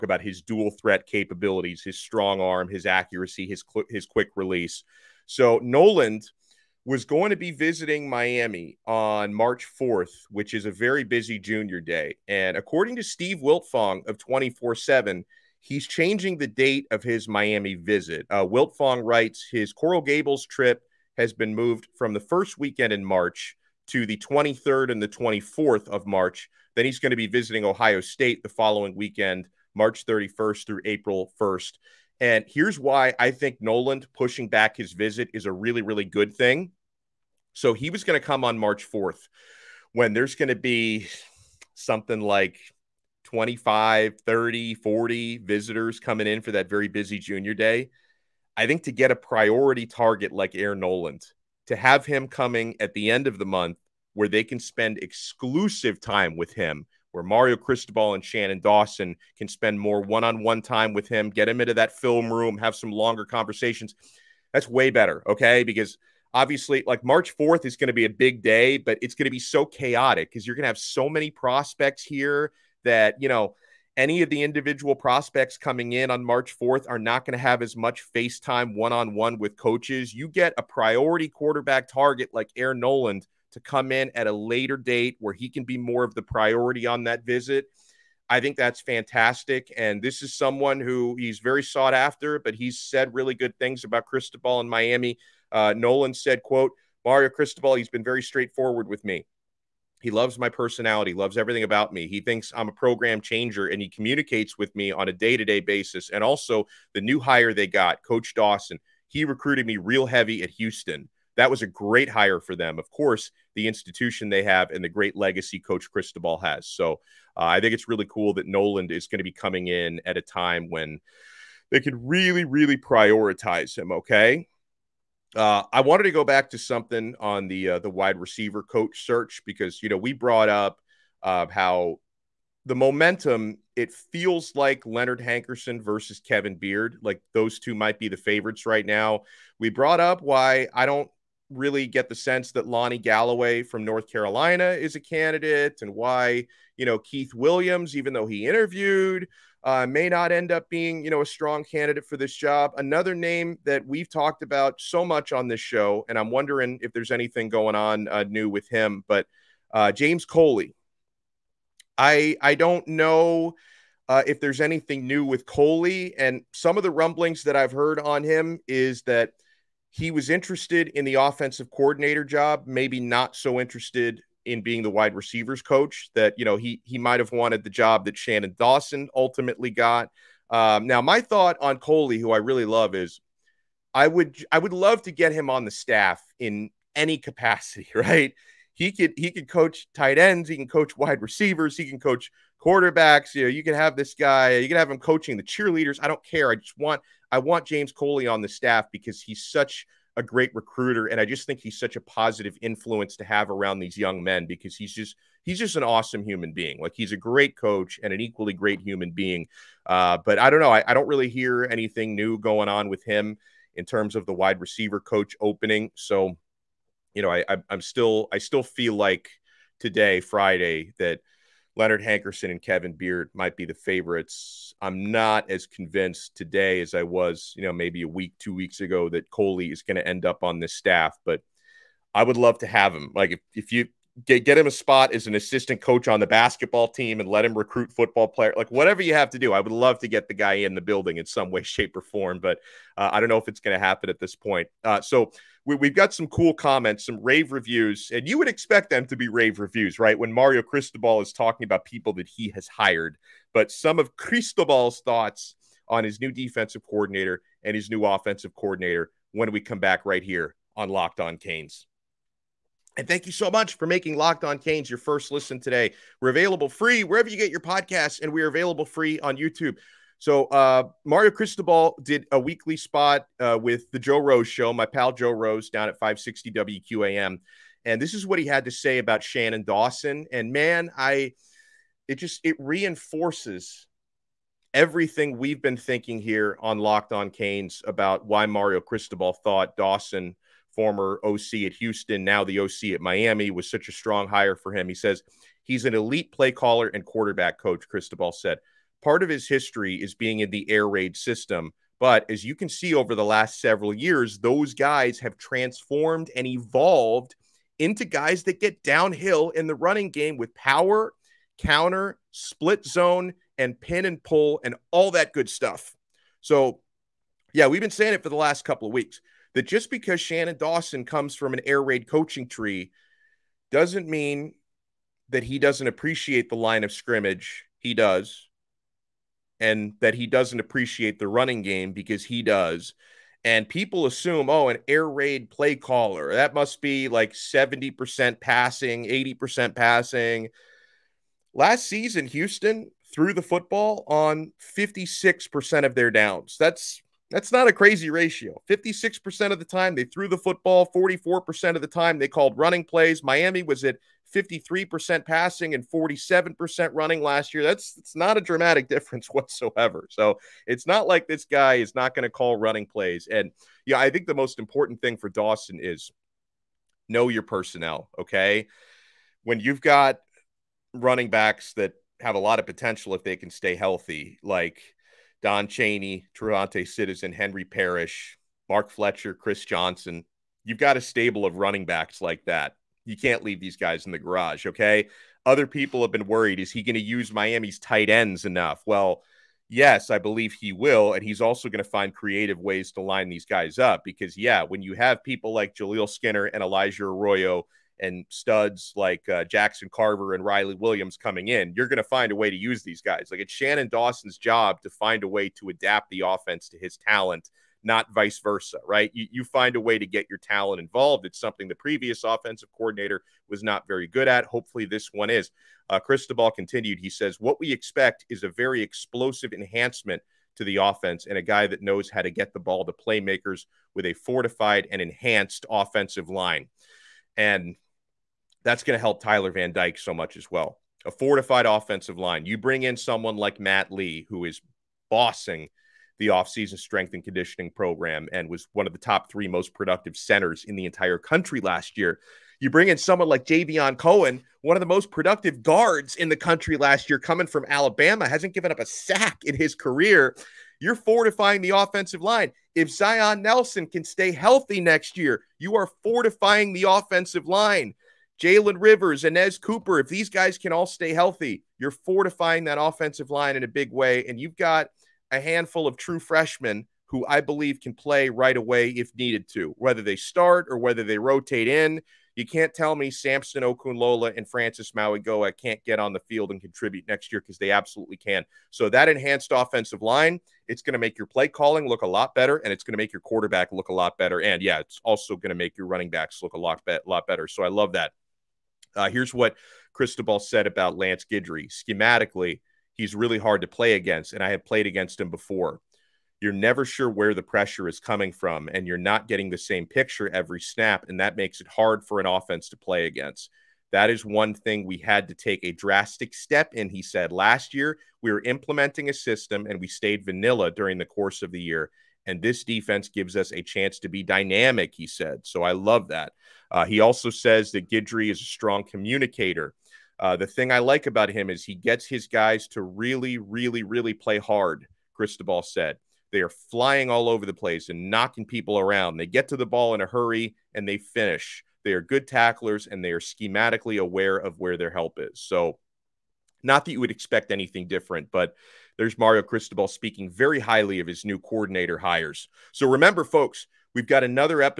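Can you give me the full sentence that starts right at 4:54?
He says he's an elite play caller and quarterback coach, Cristobal said.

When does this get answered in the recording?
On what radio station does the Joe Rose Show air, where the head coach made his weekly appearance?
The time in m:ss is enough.
4:35.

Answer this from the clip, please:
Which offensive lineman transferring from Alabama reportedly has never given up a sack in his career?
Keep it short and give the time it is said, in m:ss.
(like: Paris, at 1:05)
Javion Cohen, at 7:23.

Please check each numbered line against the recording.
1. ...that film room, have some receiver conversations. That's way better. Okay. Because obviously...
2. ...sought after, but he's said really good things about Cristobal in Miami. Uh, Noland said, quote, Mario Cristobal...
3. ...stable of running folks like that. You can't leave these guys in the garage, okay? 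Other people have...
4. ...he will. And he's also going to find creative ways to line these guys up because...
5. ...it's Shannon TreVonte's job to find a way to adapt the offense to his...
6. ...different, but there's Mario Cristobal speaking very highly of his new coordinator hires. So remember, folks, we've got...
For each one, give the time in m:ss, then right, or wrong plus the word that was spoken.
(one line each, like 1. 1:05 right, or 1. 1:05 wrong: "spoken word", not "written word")
1. 1:01 wrong: "longer", not "receiver"
2. 1:31 right
3. 6:21 wrong: "backs", not "folks"
4. 6:30 right
5. 6:43 wrong: "Dawson", not "TreVonte"
6. 8:57 right.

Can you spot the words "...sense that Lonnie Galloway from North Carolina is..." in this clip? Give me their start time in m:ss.
2:22.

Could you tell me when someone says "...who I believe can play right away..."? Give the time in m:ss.
7:47.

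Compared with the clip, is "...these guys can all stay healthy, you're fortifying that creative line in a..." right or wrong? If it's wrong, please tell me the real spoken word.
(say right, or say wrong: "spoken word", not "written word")
wrong: "offensive", not "creative".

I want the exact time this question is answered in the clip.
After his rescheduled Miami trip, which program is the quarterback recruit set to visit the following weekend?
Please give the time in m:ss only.
0:27.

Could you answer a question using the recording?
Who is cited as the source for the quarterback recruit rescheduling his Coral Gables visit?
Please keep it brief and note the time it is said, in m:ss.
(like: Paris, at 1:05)
Steve Wiltfong, at 0:13.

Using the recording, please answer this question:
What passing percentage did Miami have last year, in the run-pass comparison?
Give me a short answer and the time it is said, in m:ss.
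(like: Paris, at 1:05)
53%, at 5:54.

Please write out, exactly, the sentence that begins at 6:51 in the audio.
It's something the previous offensive coordinator was not very good at.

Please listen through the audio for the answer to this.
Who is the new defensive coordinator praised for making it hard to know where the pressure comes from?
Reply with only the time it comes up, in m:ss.
8:10.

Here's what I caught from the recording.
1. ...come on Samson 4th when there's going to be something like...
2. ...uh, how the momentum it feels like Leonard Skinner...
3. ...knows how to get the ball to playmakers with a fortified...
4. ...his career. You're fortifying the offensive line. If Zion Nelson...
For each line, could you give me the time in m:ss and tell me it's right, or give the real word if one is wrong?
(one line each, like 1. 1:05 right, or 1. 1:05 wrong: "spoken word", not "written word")
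1. 0:38 wrong: "March", not "Samson"
2. 2:11 wrong: "Hankerson", not "Skinner"
3. 7:01 right
4. 7:29 right.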